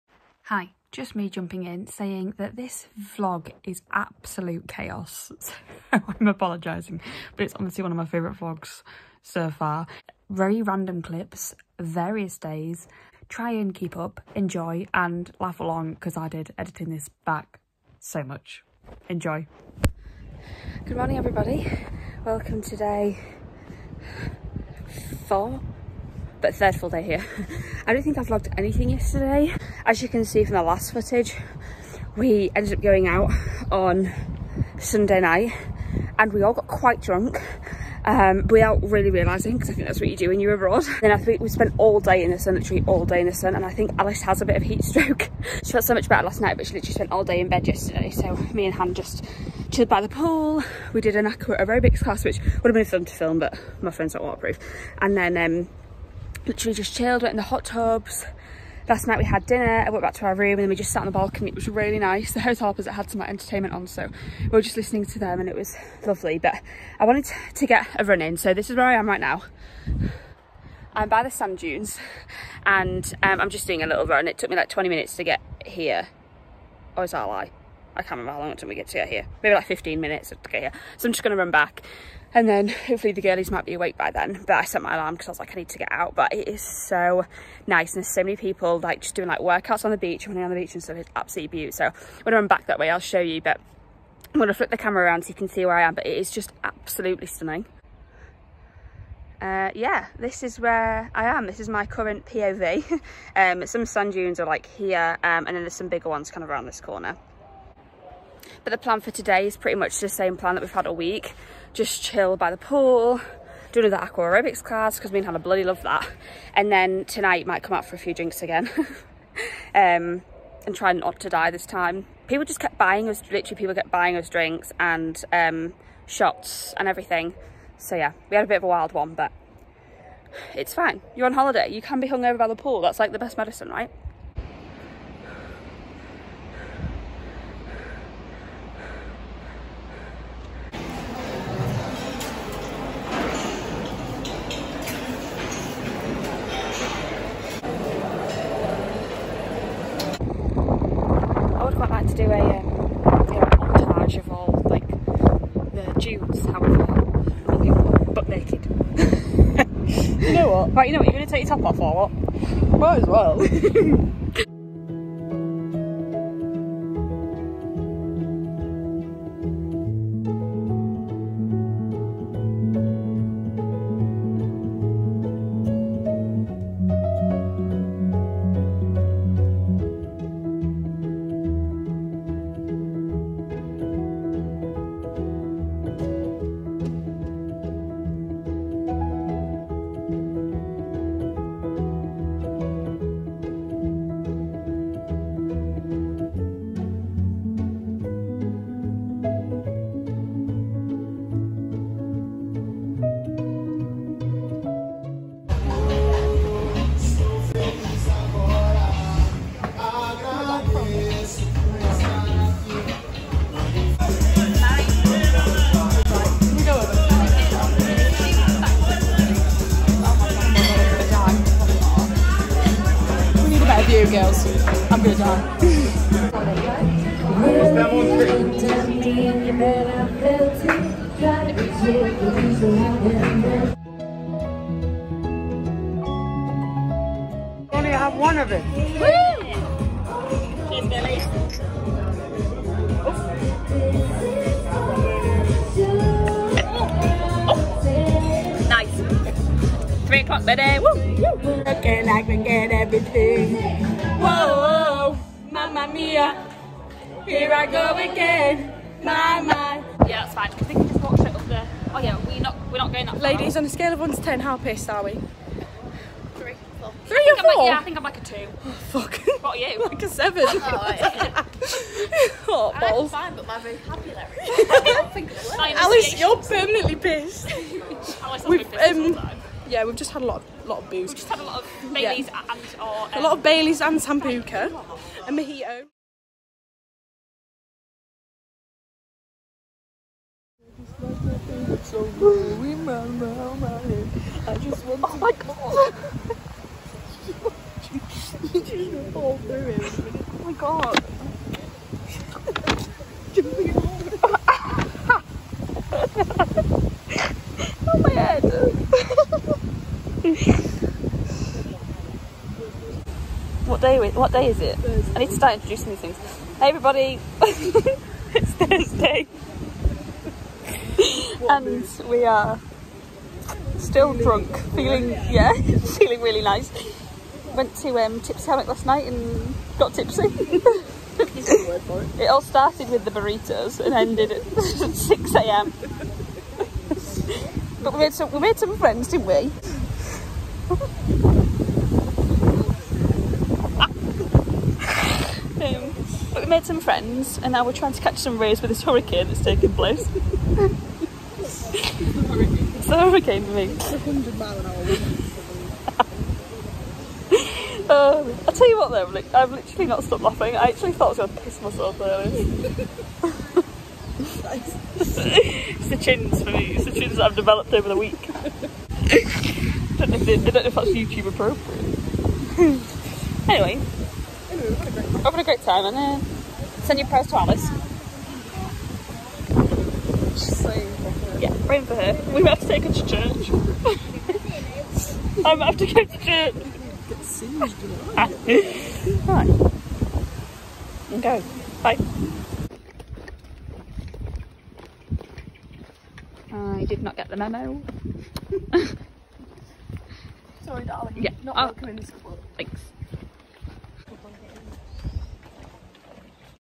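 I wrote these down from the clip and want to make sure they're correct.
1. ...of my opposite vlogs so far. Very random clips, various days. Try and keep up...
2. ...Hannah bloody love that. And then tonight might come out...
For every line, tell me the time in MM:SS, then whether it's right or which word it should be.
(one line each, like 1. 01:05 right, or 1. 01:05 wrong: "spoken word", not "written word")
1. 00:07 wrong: "favourite", not "opposite"
2. 01:55 right.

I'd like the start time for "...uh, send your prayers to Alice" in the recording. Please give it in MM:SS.
06:15.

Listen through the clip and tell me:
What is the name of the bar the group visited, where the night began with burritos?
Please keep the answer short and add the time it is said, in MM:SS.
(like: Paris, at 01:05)
Tipsy Hammock, at 05:28.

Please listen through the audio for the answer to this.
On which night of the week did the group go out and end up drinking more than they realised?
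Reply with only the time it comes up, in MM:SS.
00:34.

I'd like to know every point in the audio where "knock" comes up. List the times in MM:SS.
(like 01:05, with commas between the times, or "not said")
not said.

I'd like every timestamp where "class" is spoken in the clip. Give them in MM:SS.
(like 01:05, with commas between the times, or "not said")
00:52, 01:54.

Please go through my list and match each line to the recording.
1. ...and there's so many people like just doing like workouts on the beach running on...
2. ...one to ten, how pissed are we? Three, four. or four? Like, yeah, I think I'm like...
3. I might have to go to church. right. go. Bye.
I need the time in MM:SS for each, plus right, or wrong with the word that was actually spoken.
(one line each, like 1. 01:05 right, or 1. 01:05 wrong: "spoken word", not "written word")
1. 01:27 right
2. 04:23 right
3. 06:25 right.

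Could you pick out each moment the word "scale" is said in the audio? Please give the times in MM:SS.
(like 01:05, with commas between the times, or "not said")
04:23.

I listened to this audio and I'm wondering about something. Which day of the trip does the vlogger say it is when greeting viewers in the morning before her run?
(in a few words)
Day 4.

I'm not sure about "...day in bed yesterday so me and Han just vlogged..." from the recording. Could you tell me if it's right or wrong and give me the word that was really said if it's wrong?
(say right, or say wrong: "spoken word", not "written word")
wrong: "chilled", not "vlogged".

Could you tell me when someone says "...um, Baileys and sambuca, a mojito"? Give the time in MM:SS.
04:43.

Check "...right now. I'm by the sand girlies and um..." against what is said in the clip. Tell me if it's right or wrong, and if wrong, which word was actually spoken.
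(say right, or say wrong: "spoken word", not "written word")
wrong: "dunes", not "girlies".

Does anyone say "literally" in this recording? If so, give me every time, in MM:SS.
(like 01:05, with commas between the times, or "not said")
00:42, 00:46, 00:56, 02:03, 05:59.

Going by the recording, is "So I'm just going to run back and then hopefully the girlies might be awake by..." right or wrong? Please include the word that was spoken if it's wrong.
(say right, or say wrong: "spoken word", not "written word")
right.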